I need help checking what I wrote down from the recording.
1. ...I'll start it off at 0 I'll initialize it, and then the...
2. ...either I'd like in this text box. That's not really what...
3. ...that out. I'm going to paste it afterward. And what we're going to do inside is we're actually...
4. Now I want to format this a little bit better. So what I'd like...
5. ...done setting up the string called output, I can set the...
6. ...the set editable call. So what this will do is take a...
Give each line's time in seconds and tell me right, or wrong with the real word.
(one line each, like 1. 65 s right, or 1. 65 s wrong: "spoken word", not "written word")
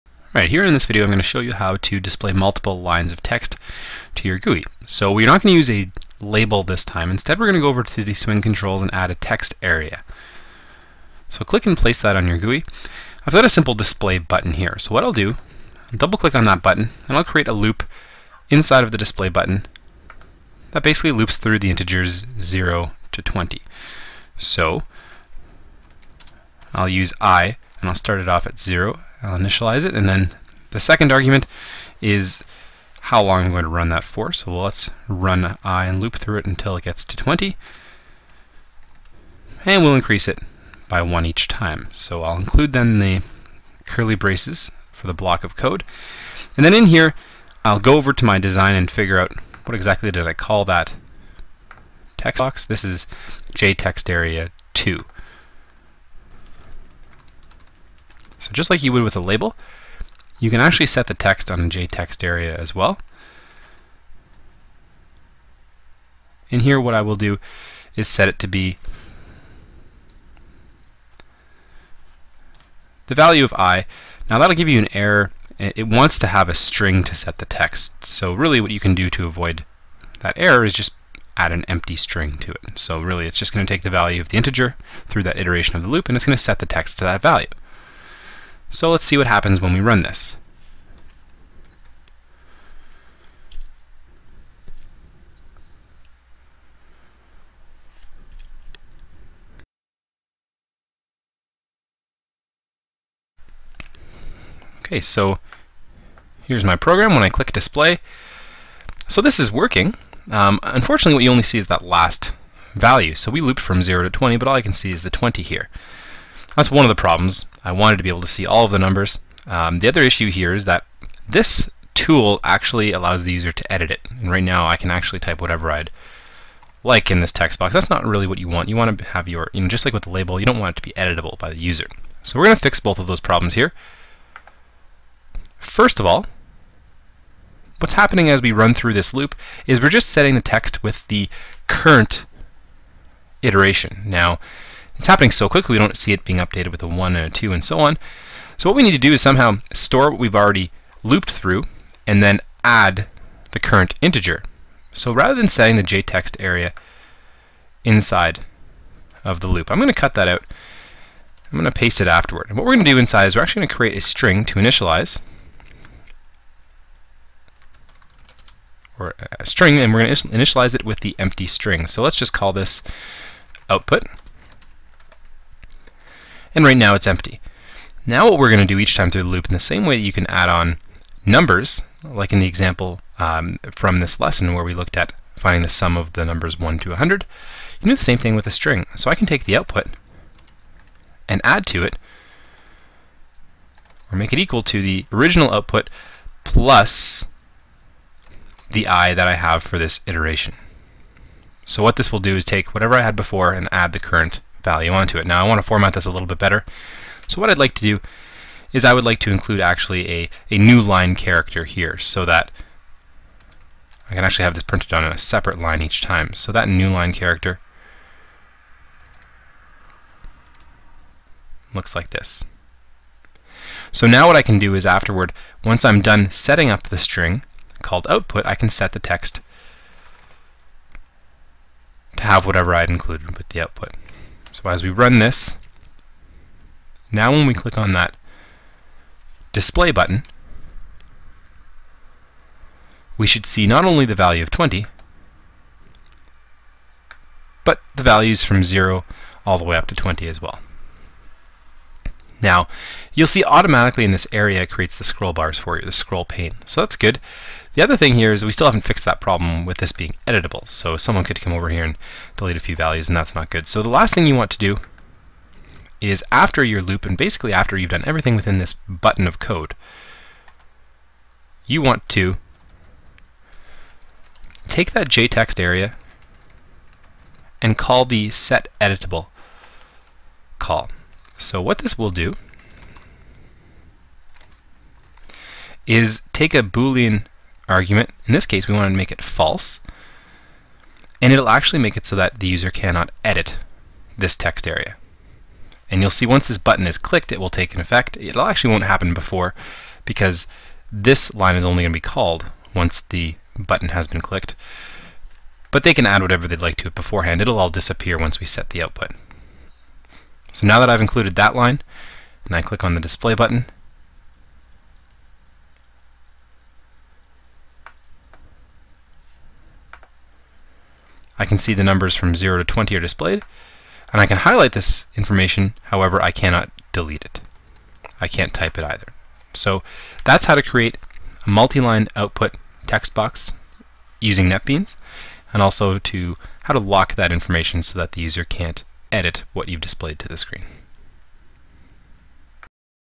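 1. 27 s right
2. 125 s wrong: "whatever", not "either"
3. 160 s right
4. 205 s right
5. 226 s right
6. 278 s right.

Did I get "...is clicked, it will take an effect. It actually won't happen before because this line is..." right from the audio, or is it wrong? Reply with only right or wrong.
right.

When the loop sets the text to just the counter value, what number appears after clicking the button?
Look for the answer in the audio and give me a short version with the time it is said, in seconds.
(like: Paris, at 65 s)
20, at 114 s.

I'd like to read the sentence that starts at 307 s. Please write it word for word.
It'll all disappear once we set the output.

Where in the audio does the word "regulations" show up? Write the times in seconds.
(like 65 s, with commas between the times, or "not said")
not said.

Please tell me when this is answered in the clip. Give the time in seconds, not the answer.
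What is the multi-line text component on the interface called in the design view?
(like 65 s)
53 s.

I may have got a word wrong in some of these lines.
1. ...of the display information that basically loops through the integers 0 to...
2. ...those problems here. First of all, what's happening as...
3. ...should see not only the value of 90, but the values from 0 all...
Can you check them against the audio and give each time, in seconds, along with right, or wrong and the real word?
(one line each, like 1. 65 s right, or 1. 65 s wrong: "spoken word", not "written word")
1. 18 s wrong: "button", not "information"
2. 133 s right
3. 243 s wrong: "20", not "90".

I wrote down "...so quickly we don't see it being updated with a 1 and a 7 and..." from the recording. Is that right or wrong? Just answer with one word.
wrong.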